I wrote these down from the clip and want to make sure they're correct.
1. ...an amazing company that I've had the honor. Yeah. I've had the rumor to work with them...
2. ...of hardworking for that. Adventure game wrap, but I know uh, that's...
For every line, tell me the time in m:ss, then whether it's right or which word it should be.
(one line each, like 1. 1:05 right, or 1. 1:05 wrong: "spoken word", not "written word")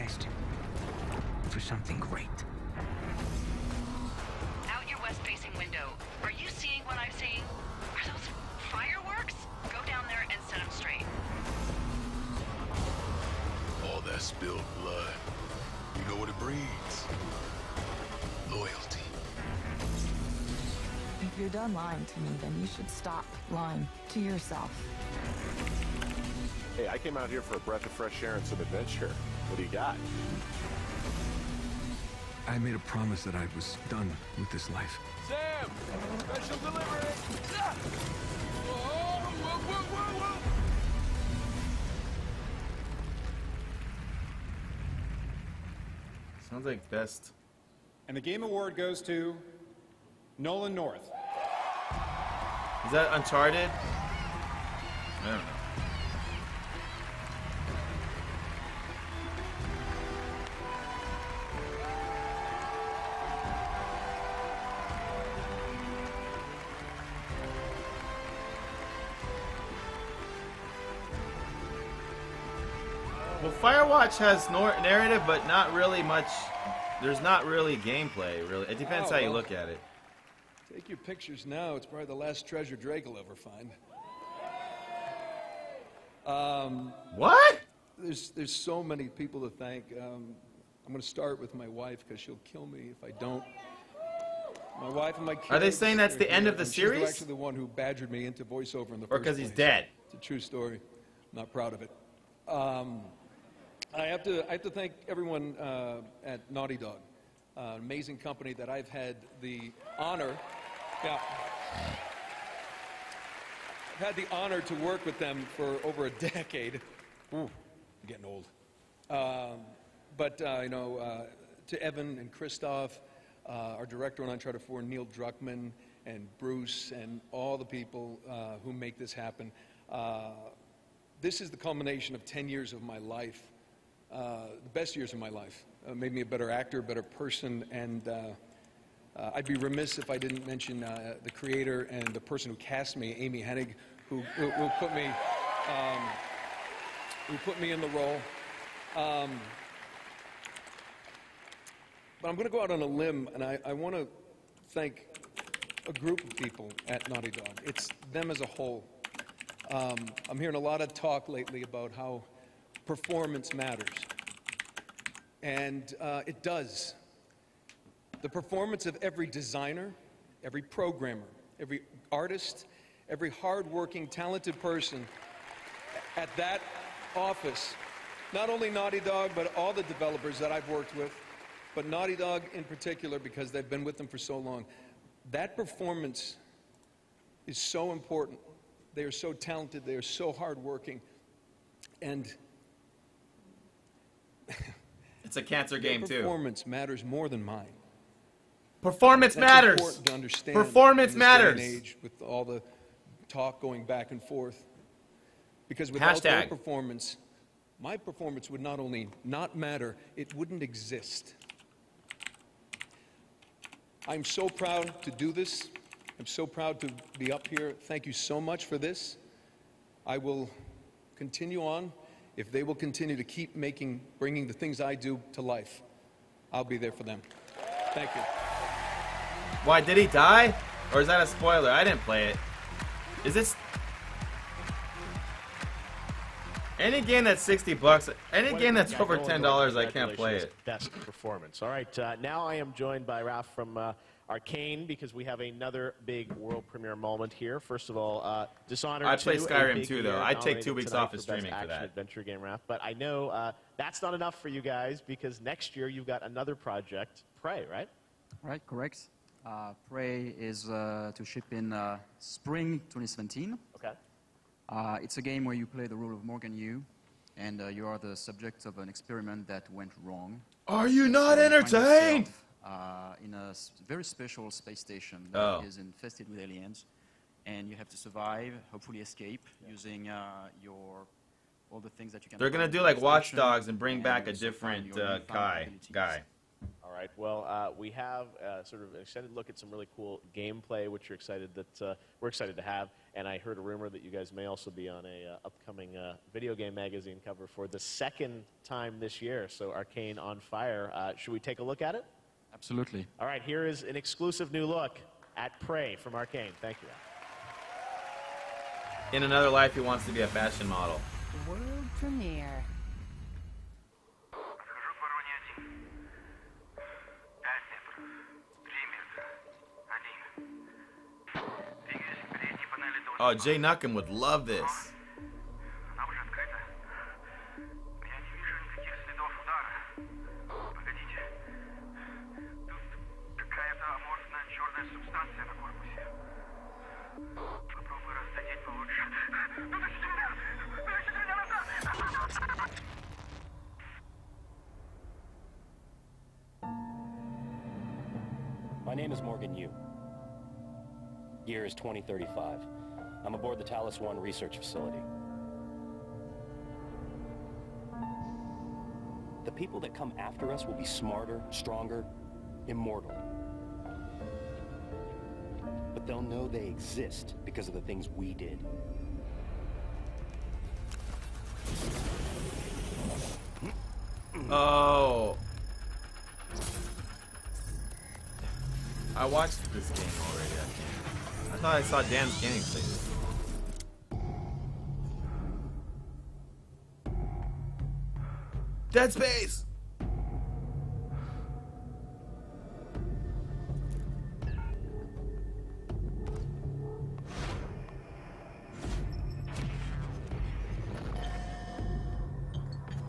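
1. 1:47 wrong: "honor", not "rumor"
2. 4:11 wrong: "streaming", not "hardworking".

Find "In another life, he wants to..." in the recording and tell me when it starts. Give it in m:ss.
5:09.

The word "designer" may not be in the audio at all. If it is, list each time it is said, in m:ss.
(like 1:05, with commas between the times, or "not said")
2:49.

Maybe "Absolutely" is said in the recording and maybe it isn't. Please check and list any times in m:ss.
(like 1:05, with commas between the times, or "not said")
5:02.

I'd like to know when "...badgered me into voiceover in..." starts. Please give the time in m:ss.
1:37.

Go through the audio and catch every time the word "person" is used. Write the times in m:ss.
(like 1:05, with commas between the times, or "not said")
2:17, 2:22, 2:54.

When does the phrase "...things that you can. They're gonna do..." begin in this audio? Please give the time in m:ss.
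4:41.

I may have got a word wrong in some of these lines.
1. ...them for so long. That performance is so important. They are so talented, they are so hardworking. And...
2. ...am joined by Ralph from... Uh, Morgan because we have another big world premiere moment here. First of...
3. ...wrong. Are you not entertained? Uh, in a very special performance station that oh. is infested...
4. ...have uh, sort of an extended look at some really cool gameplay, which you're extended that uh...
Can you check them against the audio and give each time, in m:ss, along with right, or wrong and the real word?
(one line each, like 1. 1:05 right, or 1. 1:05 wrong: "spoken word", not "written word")
1. 3:03 right
2. 4:02 wrong: "Arkane", not "Morgan"
3. 4:30 wrong: "space", not "performance"
4. 4:47 wrong: "excited", not "extended".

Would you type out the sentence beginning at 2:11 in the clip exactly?
this is the culmination of 10 years of my life uh, the best years of my life.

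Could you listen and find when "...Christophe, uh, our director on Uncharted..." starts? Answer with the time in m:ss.
2:02.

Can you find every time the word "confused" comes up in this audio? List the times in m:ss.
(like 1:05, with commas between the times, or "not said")
not said.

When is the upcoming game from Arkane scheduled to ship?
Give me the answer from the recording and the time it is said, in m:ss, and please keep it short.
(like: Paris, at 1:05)
spring 2017, at 4:22.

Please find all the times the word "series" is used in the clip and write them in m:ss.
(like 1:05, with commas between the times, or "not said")
1:36.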